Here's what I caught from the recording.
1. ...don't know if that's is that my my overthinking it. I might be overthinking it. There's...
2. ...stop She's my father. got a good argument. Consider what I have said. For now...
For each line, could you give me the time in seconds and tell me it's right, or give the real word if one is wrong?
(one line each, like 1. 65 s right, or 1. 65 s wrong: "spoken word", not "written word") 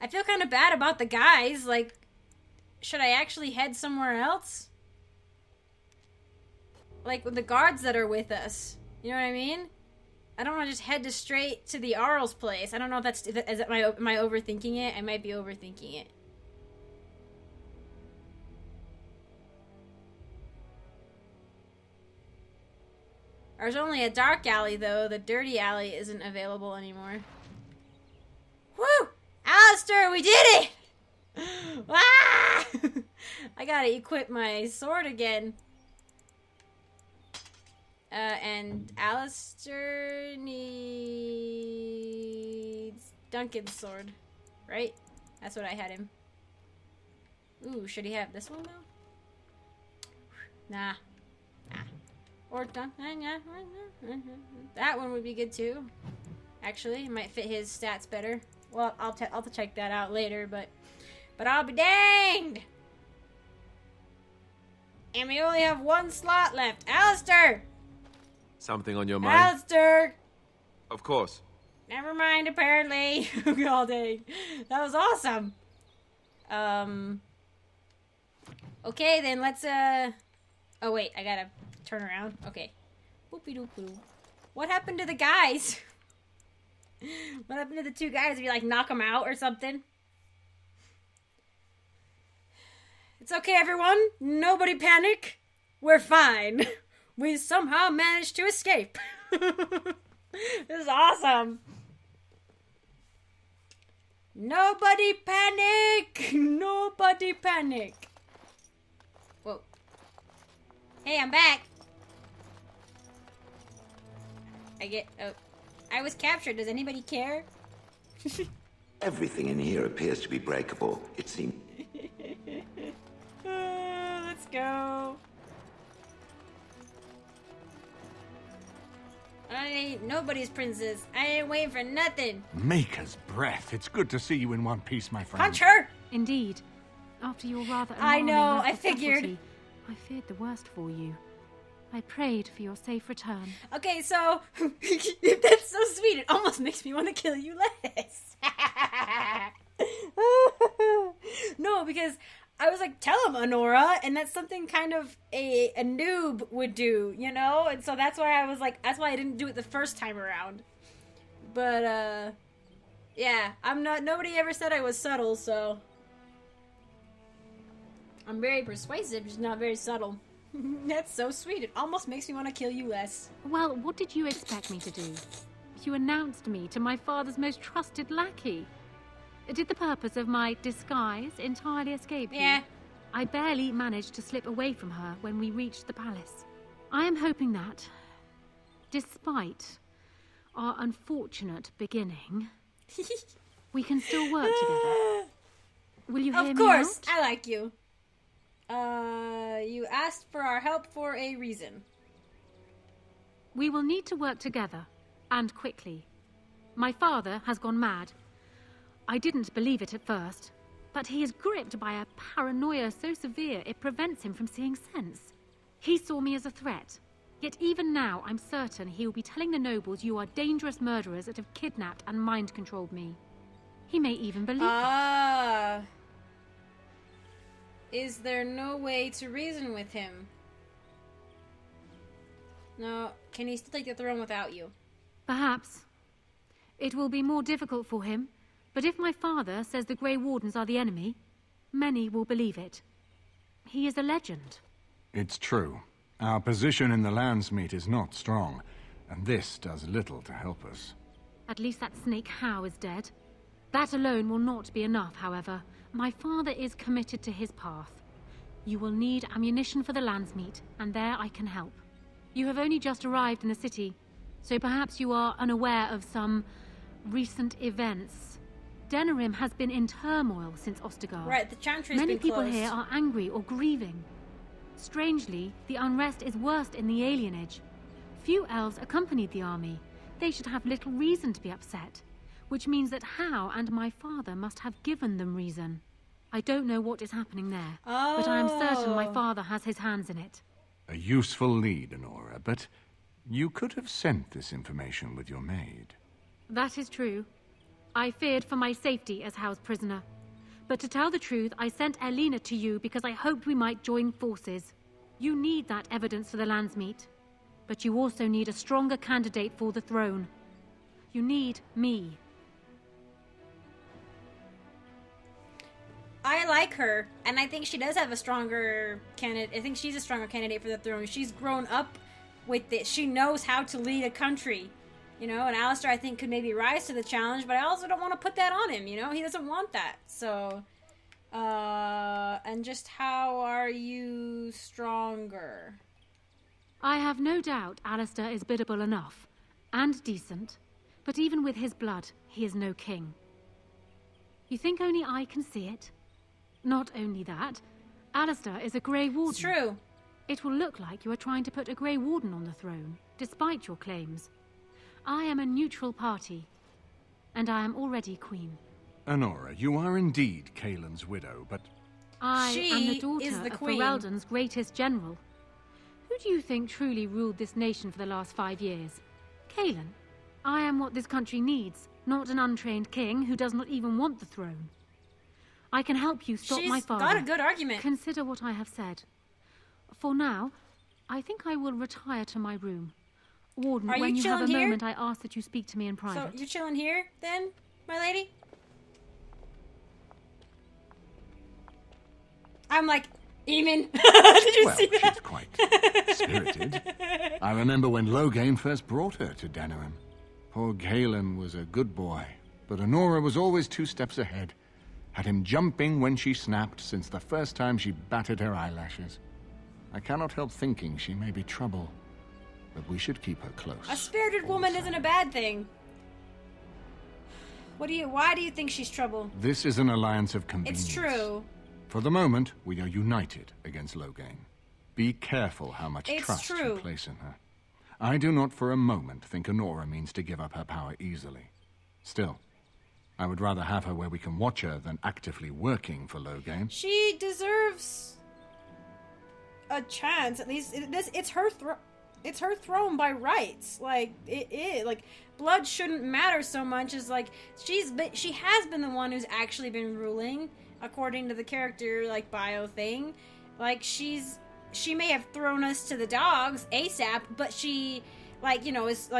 1. 12 s right
2. 376 s right.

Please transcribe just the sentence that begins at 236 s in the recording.
It will be more difficult for him, but if my father says the Grey Wardens are the enemy, many will believe it.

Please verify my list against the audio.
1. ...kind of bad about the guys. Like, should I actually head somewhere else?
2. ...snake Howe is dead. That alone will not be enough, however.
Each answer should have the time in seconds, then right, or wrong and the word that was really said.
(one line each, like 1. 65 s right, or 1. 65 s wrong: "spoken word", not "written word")
1. 0 s right
2. 252 s right.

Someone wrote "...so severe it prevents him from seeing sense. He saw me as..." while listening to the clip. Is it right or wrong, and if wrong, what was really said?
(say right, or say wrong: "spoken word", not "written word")
right.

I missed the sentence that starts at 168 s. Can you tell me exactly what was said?
I'm very persuasive, just not very subtle.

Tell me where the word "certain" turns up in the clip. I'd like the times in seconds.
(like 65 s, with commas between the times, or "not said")
218 s, 288 s.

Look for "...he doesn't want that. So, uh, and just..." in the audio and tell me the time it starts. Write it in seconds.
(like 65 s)
329 s.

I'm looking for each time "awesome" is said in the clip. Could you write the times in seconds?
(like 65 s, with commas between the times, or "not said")
74 s, 100 s.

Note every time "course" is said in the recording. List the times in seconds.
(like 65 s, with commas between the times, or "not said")
71 s, 196 s.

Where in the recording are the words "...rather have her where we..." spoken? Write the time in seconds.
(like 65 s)
433 s.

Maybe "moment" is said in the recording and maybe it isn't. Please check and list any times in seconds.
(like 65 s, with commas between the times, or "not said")
384 s, 422 s, 428 s.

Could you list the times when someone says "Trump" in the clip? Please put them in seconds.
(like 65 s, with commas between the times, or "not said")
not said.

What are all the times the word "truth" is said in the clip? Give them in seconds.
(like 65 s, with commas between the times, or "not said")
301 s.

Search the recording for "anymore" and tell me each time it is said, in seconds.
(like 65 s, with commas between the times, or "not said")
26 s.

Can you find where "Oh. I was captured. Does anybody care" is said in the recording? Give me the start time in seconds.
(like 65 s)
115 s.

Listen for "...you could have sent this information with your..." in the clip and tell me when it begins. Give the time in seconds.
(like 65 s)
293 s.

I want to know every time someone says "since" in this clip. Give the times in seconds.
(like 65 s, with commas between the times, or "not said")
270 s, 406 s.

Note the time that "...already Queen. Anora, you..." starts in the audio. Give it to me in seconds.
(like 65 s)
357 s.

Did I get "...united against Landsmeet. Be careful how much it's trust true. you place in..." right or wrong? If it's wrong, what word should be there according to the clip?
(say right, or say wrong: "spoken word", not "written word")
wrong: "Loghain", not "Landsmeet".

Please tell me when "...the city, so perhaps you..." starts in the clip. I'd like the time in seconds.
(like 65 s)
263 s.